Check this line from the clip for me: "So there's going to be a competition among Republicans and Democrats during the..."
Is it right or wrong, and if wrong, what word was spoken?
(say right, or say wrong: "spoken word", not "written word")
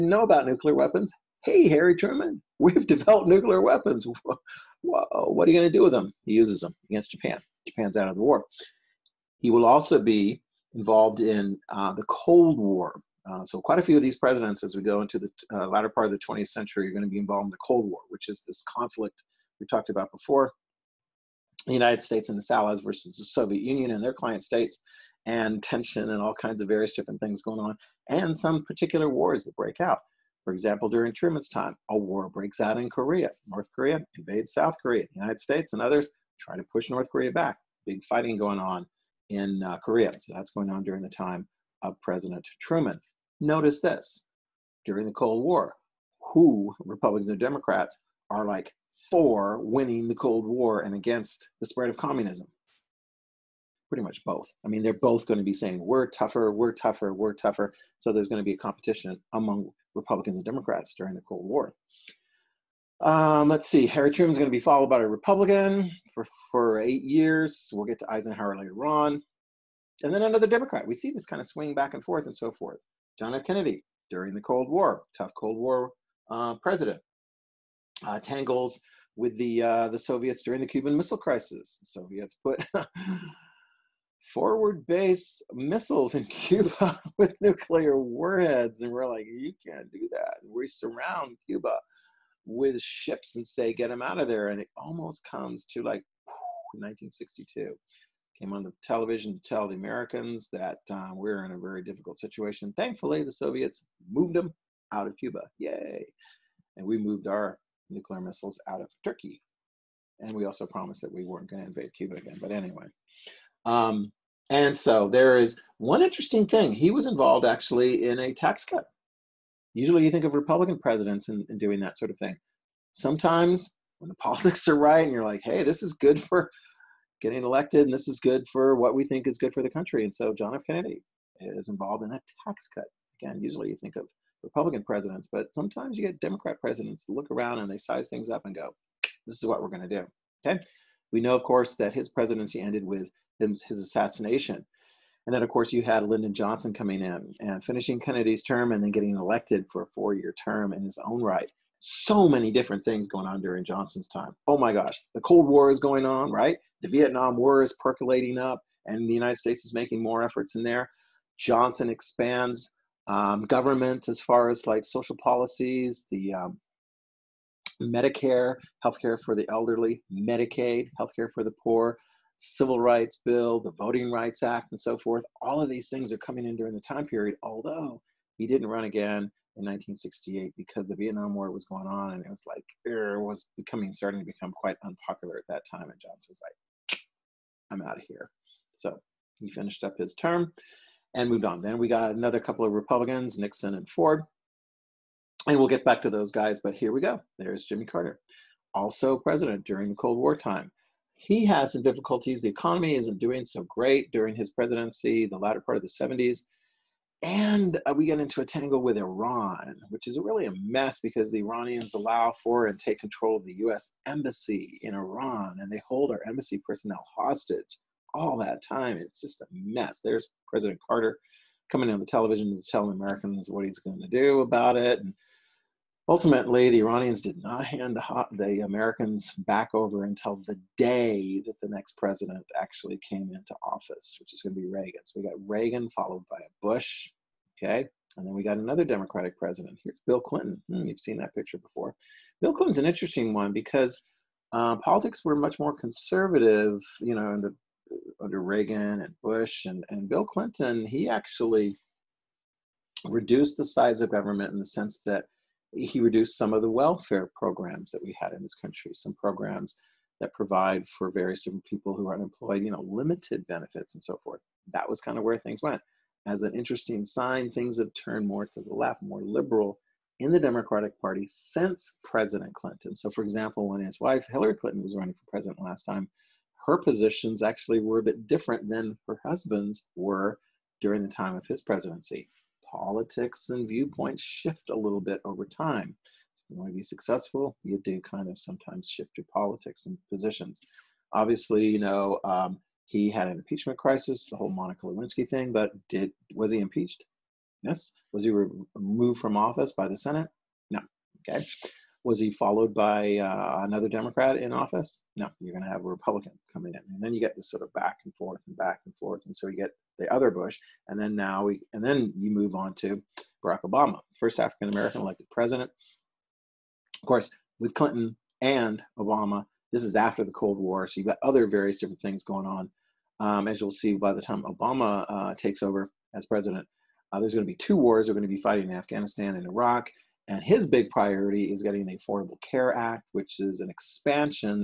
right.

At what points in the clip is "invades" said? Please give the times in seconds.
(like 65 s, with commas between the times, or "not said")
34 s, 111 s.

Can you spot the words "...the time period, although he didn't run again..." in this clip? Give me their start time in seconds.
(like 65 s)
176 s.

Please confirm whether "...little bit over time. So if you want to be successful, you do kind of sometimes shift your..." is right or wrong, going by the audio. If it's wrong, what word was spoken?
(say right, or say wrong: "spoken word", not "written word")
right.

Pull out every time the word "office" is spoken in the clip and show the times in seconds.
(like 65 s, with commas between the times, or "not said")
233 s, 299 s, 304 s.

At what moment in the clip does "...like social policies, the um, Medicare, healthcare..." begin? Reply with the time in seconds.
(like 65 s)
164 s.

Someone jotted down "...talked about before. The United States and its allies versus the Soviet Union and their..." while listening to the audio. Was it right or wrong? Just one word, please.
right.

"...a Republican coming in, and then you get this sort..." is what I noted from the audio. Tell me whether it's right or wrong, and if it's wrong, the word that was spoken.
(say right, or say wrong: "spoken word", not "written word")
right.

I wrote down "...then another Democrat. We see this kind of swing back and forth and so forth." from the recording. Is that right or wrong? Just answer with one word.
right.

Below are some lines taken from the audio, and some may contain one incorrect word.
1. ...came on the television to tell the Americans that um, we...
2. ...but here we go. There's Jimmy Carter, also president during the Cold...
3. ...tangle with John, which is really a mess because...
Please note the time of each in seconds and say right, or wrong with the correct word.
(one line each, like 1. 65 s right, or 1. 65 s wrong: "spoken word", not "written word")
1. 98 s right
2. 196 s right
3. 208 s wrong: "Iran", not "John".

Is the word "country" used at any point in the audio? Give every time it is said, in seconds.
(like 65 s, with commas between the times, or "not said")
129 s, 258 s.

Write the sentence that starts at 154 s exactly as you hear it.
Oh my gosh, the Cold War is going on, right?